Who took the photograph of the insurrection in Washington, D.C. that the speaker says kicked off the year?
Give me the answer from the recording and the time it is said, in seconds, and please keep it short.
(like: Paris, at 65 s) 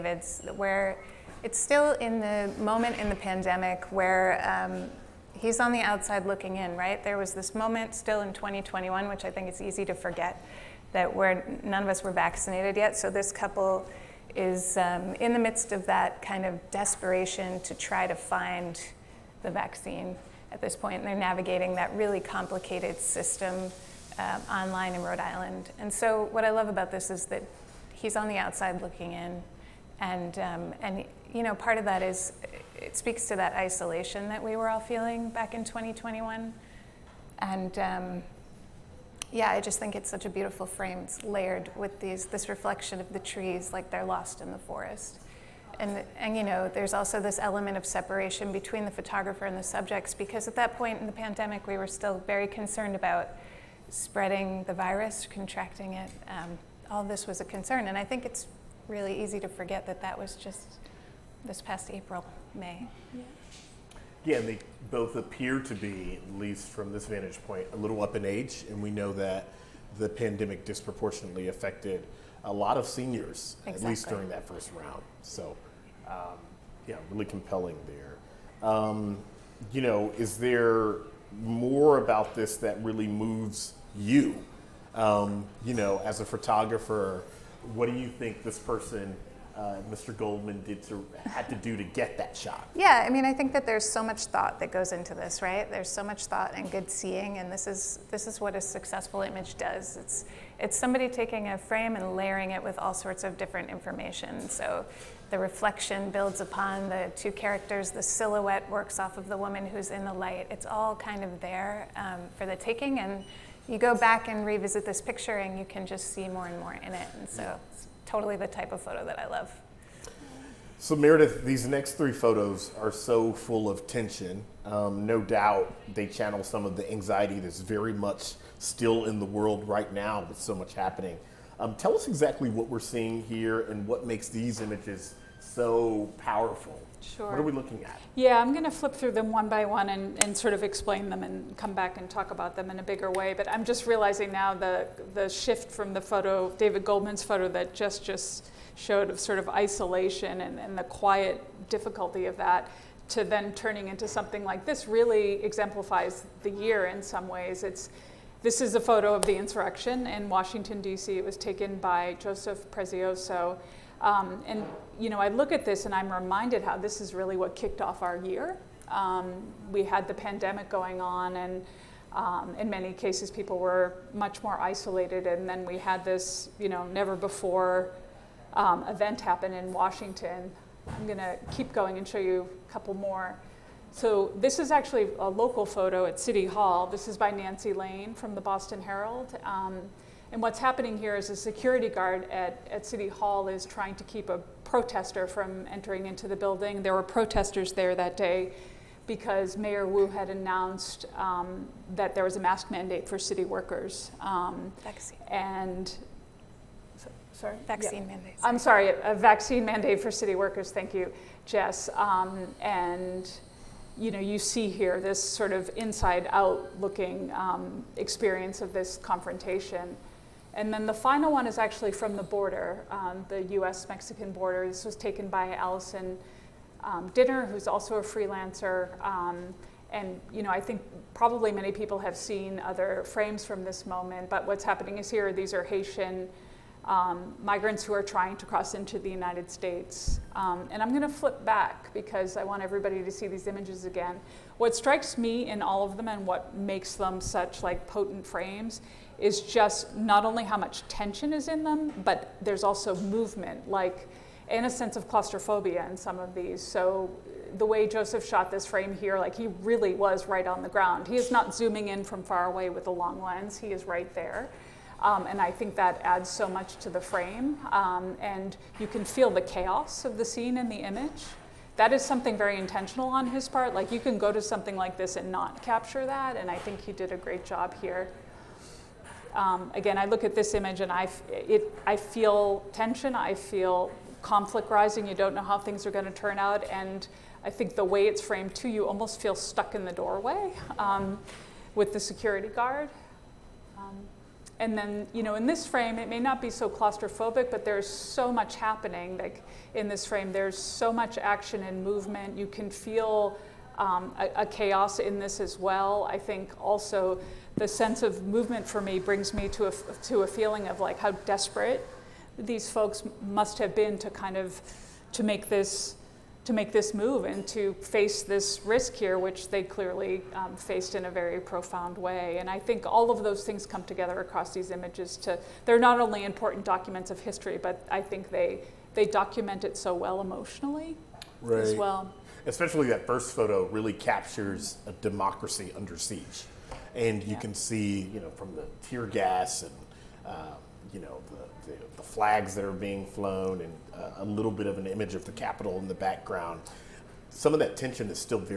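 Joseph Prezioso, at 162 s.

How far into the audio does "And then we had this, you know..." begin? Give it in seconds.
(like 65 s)
175 s.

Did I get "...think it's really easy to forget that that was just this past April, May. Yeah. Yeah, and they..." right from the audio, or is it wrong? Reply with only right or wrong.
right.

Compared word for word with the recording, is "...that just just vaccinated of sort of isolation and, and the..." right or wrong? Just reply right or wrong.
wrong.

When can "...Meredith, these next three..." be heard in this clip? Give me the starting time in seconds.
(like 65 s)
120 s.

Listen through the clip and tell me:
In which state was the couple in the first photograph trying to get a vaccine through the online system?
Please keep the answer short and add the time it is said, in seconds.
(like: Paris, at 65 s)
Rhode Island, at 25 s.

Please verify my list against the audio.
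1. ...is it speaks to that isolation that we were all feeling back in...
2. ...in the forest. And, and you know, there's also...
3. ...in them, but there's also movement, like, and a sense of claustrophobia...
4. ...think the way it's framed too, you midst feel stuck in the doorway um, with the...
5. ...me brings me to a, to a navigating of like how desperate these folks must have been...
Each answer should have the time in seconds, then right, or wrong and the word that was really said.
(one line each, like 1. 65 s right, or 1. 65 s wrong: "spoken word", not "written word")
1. 32 s right
2. 44 s right
3. 251 s right
4. 287 s wrong: "almost", not "midst"
5. 308 s wrong: "feeling", not "navigating".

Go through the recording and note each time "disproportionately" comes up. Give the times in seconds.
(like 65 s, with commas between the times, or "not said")
70 s.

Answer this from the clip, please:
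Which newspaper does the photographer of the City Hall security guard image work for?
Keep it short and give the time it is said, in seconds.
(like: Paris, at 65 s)
Boston Herald, at 188 s.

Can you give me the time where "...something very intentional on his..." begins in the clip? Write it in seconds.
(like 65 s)
272 s.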